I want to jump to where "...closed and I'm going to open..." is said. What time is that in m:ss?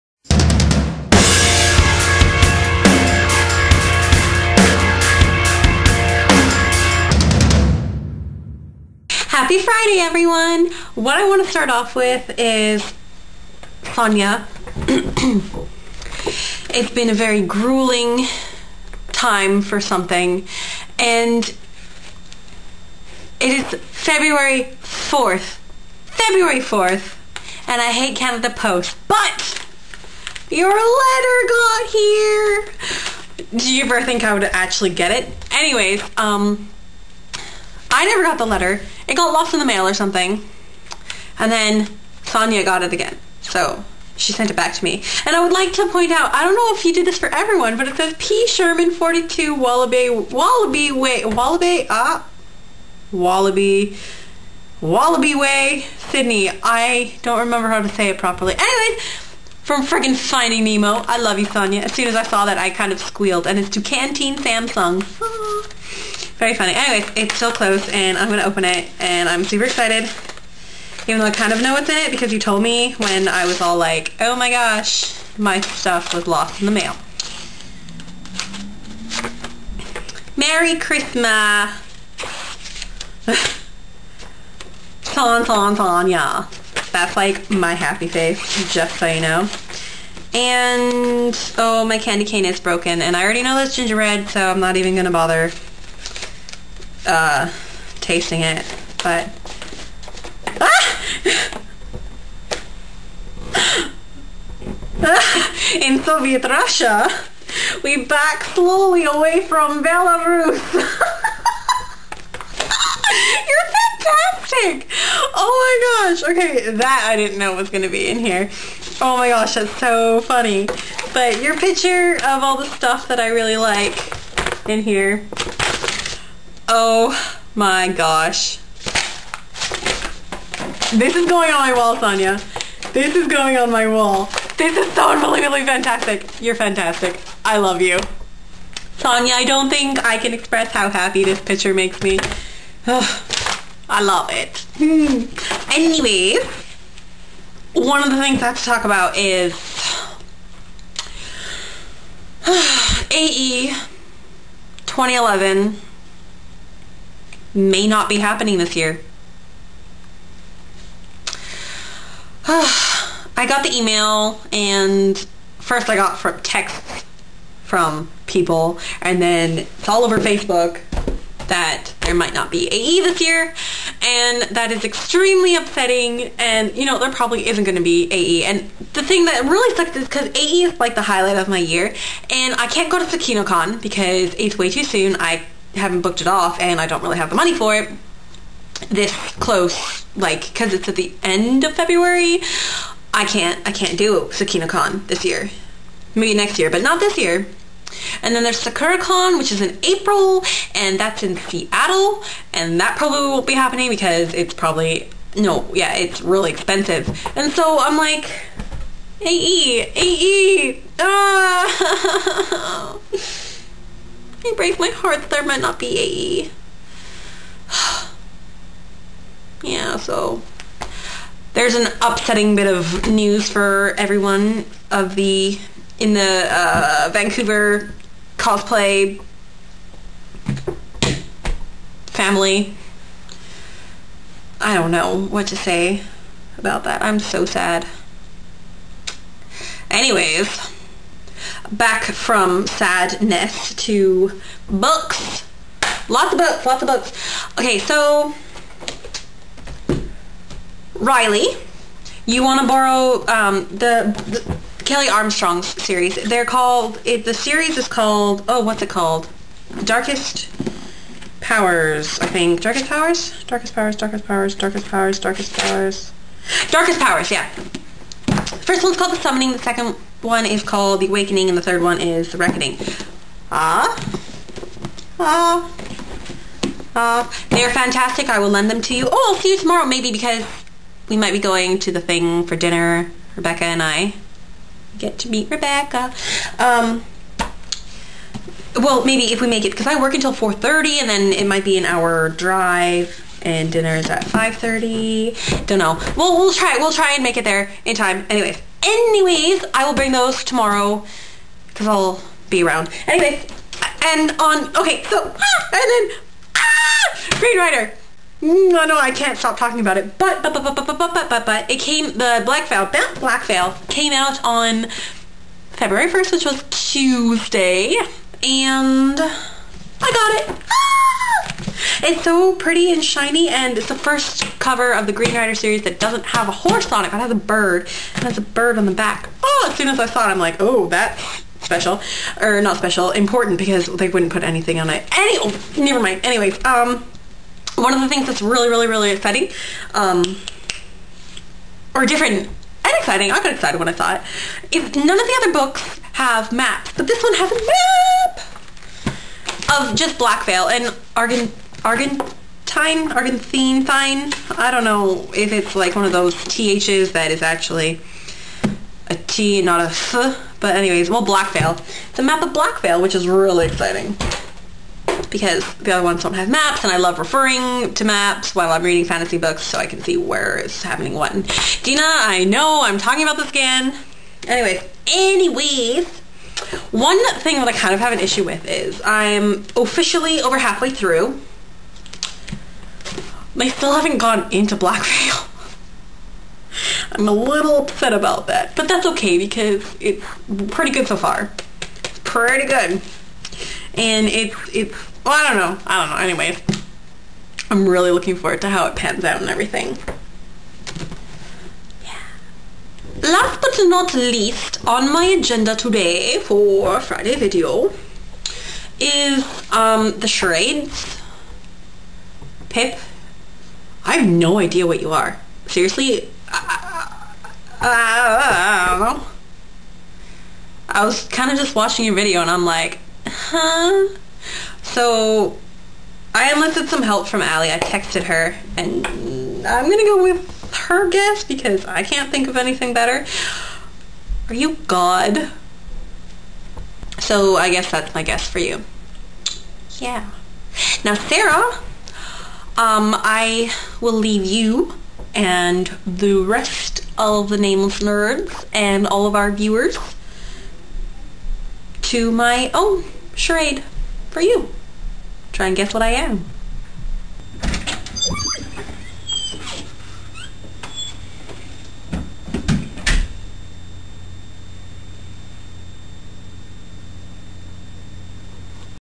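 1:07.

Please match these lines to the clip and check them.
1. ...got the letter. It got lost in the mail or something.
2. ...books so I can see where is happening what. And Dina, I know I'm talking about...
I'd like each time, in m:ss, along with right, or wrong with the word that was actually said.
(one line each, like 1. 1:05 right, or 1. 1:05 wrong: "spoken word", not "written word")
1. 0:38 right
2. 6:09 right.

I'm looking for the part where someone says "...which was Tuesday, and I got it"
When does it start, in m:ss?
5:16.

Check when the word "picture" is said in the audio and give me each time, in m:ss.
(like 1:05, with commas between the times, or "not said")
2:01, 2:21.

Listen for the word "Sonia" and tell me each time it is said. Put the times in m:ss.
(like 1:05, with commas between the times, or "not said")
0:13, 0:42, 1:01, 2:11, 2:18.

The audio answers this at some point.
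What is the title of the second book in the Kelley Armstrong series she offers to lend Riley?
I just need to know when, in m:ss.
4:30.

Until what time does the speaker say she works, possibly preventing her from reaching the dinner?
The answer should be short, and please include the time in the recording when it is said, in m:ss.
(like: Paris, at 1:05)
4:30, at 4:50.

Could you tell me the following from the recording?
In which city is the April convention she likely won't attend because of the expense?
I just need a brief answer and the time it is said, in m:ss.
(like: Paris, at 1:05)
Seattle, at 3:21.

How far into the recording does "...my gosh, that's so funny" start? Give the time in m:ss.
1:59.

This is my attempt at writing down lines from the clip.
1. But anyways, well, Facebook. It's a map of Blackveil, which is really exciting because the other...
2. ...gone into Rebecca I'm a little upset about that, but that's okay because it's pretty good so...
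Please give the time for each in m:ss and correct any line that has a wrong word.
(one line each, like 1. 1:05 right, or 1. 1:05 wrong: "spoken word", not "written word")
1. 6:00 wrong: "Blackveil", not "Facebook"
2. 6:24 wrong: "Black", not "Rebecca".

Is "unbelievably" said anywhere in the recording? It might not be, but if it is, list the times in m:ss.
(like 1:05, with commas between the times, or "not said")
2:15.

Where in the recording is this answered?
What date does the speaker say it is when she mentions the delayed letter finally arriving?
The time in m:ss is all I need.
0:26.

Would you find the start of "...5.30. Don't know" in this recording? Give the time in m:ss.
4:54.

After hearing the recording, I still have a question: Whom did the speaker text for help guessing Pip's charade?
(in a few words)
Allie.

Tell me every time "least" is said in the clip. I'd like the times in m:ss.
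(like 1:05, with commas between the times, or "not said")
6:44.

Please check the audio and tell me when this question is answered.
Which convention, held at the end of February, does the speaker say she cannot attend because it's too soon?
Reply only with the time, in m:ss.
3:03.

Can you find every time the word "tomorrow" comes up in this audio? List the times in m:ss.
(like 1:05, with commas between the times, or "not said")
4:39, 5:00.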